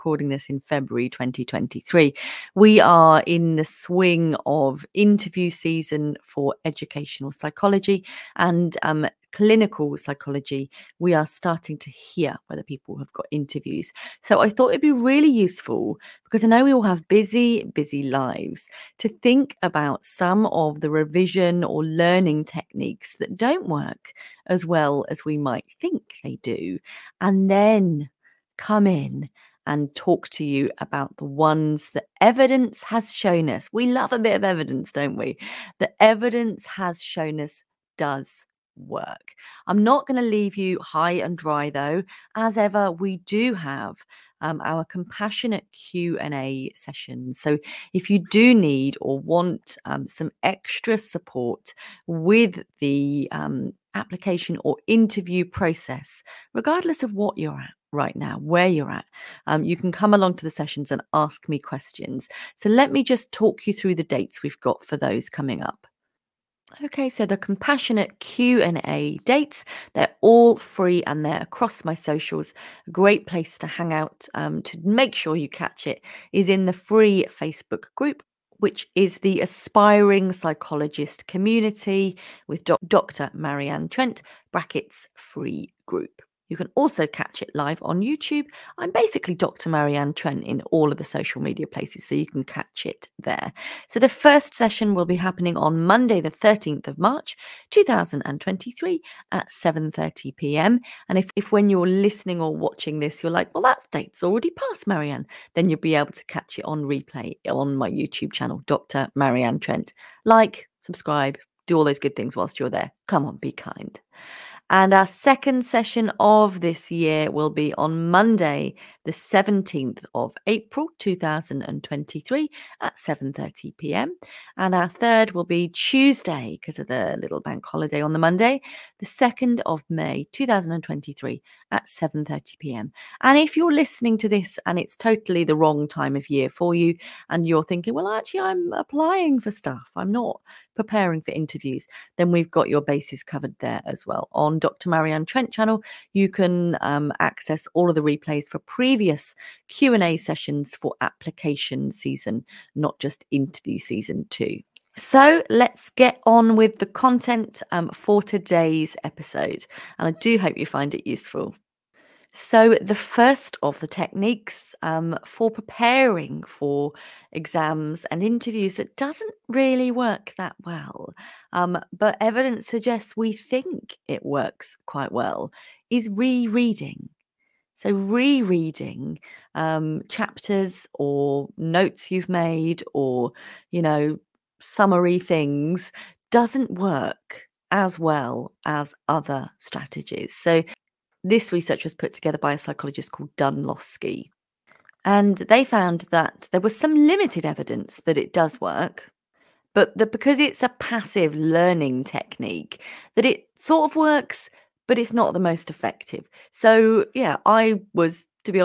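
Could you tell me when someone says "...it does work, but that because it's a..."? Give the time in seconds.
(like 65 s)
198 s.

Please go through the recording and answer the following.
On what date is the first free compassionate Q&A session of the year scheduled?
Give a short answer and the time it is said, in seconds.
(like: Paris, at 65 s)
13 March 2023, at 95 s.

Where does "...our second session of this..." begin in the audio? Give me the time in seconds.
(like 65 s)
114 s.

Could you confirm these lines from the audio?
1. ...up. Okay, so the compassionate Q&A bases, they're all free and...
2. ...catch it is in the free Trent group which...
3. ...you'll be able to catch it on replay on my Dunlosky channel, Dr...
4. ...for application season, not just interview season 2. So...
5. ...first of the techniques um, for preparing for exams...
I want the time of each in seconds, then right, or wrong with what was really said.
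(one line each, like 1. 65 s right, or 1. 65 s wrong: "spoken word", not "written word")
1. 65 s wrong: "dates", not "bases"
2. 75 s wrong: "Facebook", not "Trent"
3. 105 s wrong: "YouTube", not "Dunlosky"
4. 150 s right
5. 162 s right.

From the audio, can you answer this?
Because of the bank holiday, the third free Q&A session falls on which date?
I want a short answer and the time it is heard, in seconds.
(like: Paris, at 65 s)
2 May 2023, at 128 s.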